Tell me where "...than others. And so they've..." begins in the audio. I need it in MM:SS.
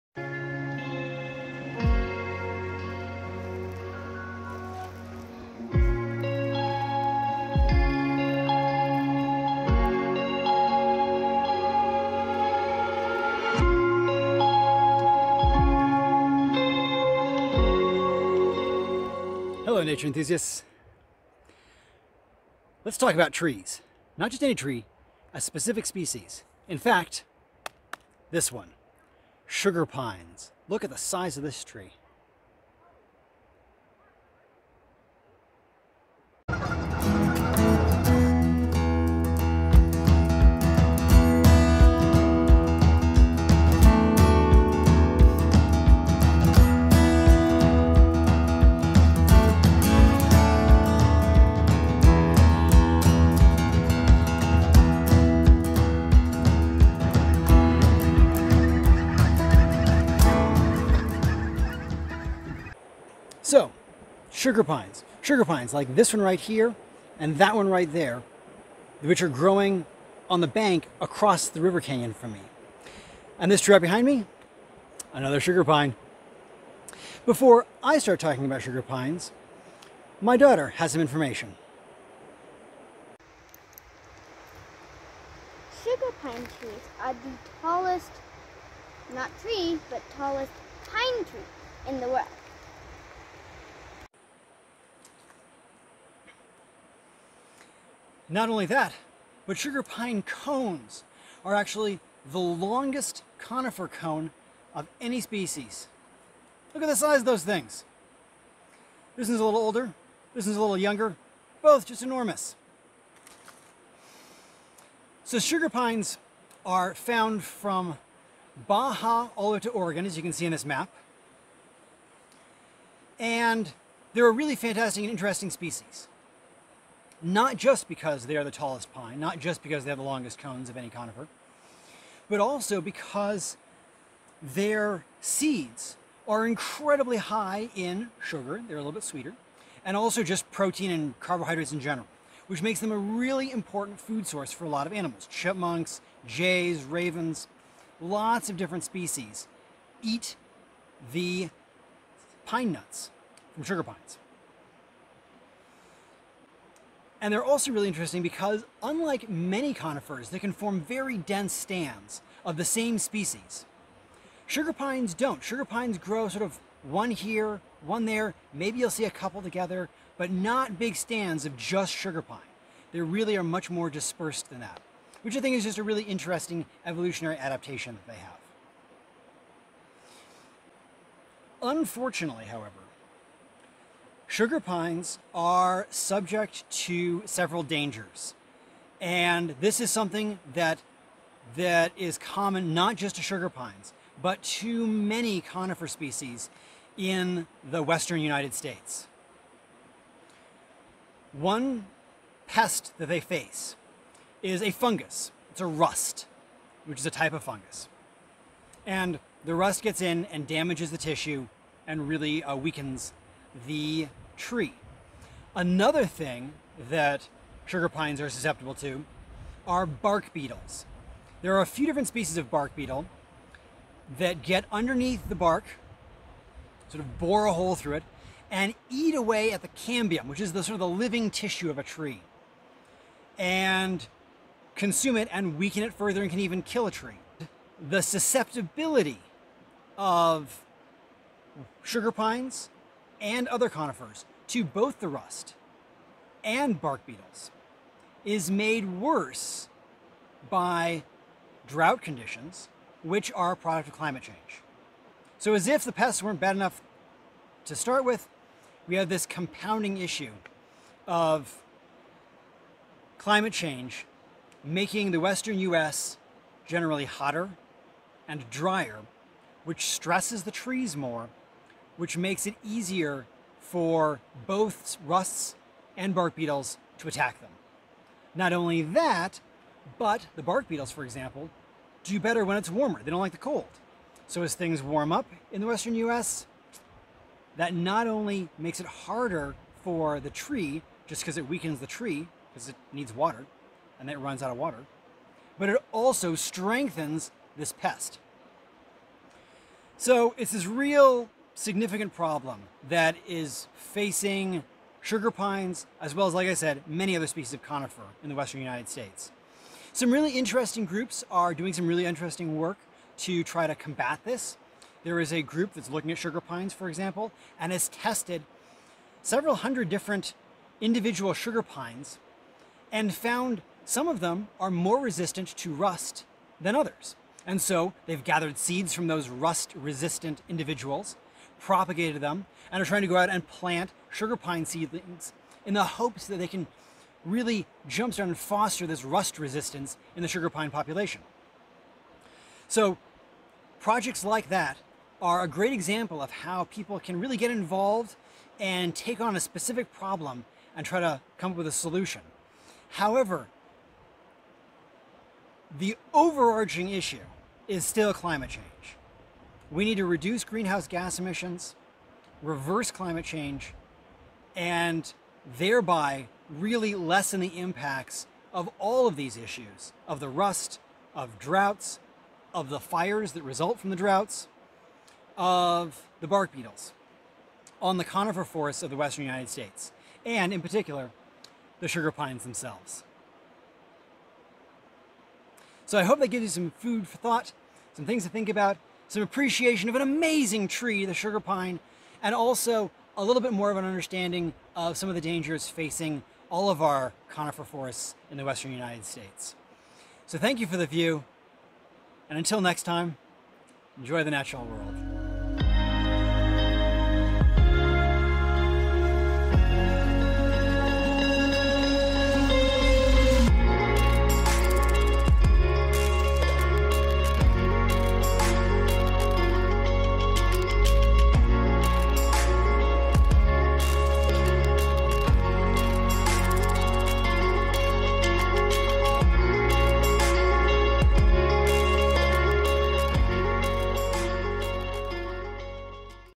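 05:26.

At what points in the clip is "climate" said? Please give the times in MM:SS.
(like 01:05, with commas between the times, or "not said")
04:13, 04:23, 05:58, 06:02.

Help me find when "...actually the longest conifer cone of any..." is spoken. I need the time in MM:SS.
01:41.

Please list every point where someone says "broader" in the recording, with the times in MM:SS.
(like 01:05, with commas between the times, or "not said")
not said.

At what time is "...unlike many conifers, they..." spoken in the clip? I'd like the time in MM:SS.
02:38.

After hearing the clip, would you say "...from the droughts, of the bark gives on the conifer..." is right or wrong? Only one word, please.
wrong.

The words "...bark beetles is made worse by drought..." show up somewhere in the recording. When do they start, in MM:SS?
04:06.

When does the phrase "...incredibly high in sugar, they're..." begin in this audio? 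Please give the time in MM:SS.
02:16.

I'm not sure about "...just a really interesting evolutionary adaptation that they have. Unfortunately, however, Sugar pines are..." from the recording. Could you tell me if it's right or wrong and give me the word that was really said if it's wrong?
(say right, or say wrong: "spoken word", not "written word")
right.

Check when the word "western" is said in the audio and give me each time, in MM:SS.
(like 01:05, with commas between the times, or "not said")
03:17, 04:25, 04:45, 05:08, 06:18, 06:38.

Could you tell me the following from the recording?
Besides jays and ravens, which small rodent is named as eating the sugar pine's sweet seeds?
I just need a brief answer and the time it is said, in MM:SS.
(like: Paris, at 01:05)
Chipmunks, at 02:25.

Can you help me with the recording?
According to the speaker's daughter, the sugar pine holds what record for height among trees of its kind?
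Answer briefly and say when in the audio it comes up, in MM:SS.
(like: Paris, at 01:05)
Tallest pine tree in the world, at 01:30.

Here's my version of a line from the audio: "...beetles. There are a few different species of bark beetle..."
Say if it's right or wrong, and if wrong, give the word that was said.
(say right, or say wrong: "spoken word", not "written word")
right.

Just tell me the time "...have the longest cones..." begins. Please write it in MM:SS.
02:09.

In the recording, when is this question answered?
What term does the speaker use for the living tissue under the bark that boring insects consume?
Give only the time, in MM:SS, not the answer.
03:49.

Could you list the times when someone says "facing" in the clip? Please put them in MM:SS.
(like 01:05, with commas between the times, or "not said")
05:03, 06:35.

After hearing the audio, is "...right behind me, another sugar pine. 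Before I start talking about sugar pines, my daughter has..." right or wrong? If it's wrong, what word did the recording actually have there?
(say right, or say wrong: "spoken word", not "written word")
right.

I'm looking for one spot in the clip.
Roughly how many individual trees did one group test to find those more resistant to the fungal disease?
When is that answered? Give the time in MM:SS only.
05:19.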